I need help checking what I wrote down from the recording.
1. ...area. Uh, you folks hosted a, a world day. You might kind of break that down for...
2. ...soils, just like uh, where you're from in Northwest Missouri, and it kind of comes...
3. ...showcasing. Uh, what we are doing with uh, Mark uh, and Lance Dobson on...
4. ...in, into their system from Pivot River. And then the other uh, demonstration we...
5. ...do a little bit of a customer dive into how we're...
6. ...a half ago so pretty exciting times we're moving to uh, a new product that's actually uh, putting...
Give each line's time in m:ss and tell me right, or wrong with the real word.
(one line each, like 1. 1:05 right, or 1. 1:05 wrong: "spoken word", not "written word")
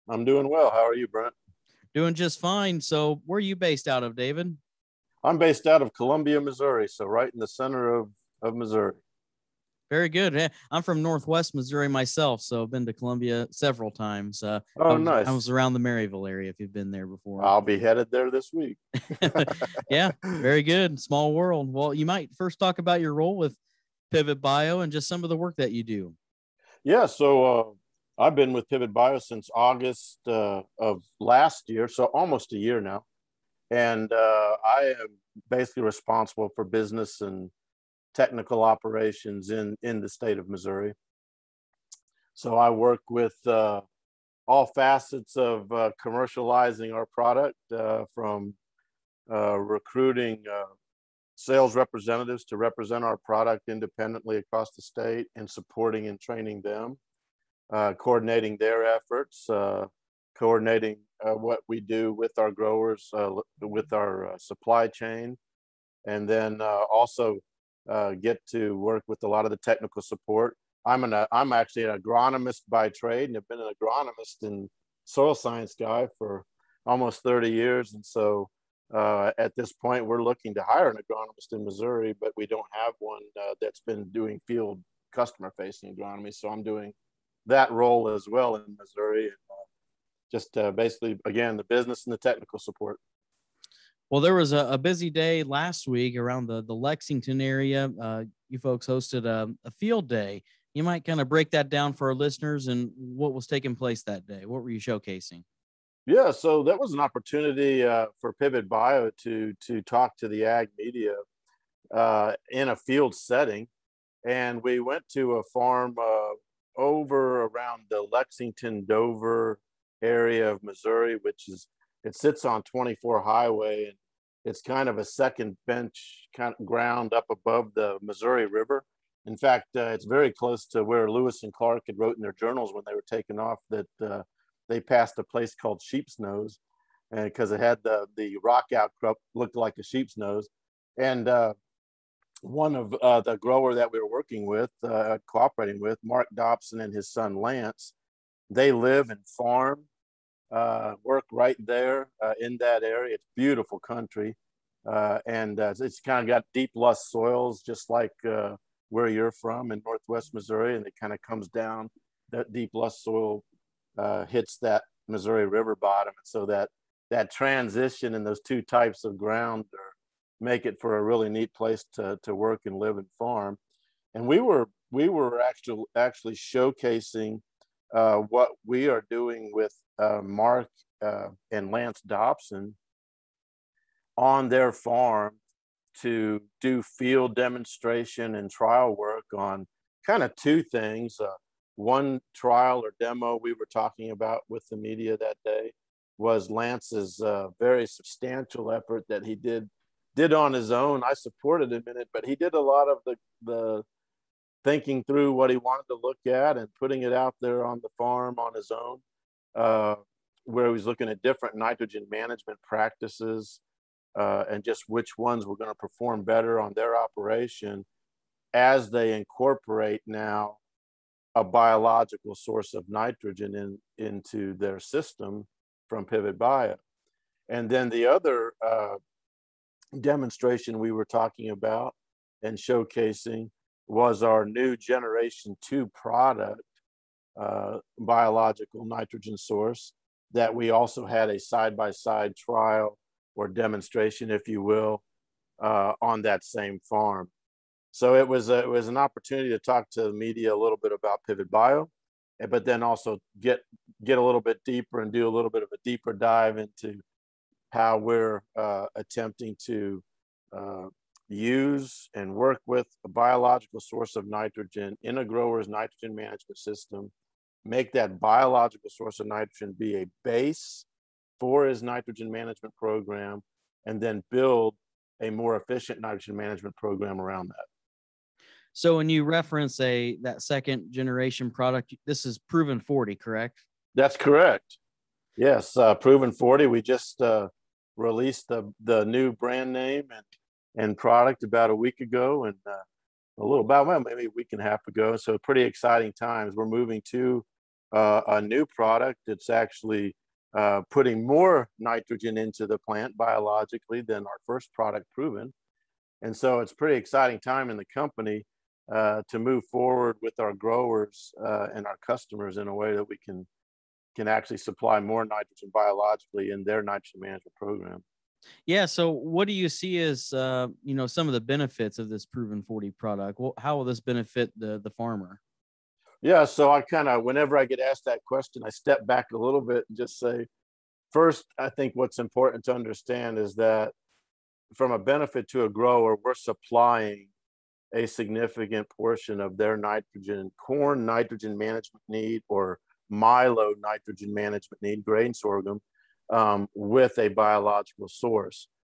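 1. 1:37 wrong: "field", not "world"
2. 2:37 right
3. 2:56 right
4. 3:43 wrong: "Bio", not "River"
5. 4:15 wrong: "deeper", not "customer"
6. 4:54 right.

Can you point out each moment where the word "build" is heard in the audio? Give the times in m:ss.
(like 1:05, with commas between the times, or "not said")
4:34.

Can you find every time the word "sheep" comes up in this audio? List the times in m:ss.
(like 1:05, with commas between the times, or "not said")
2:15, 2:19.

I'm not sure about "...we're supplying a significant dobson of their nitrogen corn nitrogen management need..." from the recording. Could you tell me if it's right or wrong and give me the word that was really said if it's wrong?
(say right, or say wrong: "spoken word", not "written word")
wrong: "portion", not "dobson".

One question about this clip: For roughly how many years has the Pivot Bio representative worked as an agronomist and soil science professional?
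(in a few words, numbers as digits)
30 years.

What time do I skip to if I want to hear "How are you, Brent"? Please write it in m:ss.
0:00.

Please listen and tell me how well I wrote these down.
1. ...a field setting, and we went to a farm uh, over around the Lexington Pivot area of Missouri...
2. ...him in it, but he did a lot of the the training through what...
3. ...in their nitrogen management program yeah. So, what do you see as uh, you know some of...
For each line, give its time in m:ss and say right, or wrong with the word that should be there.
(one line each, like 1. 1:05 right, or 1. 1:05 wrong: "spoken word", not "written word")
1. 1:52 wrong: "Dover", not "Pivot"
2. 3:21 wrong: "thinking", not "training"
3. 5:16 right.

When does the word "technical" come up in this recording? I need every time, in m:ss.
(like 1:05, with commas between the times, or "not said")
0:38, 1:09, 1:32.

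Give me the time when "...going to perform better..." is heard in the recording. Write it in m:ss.
3:35.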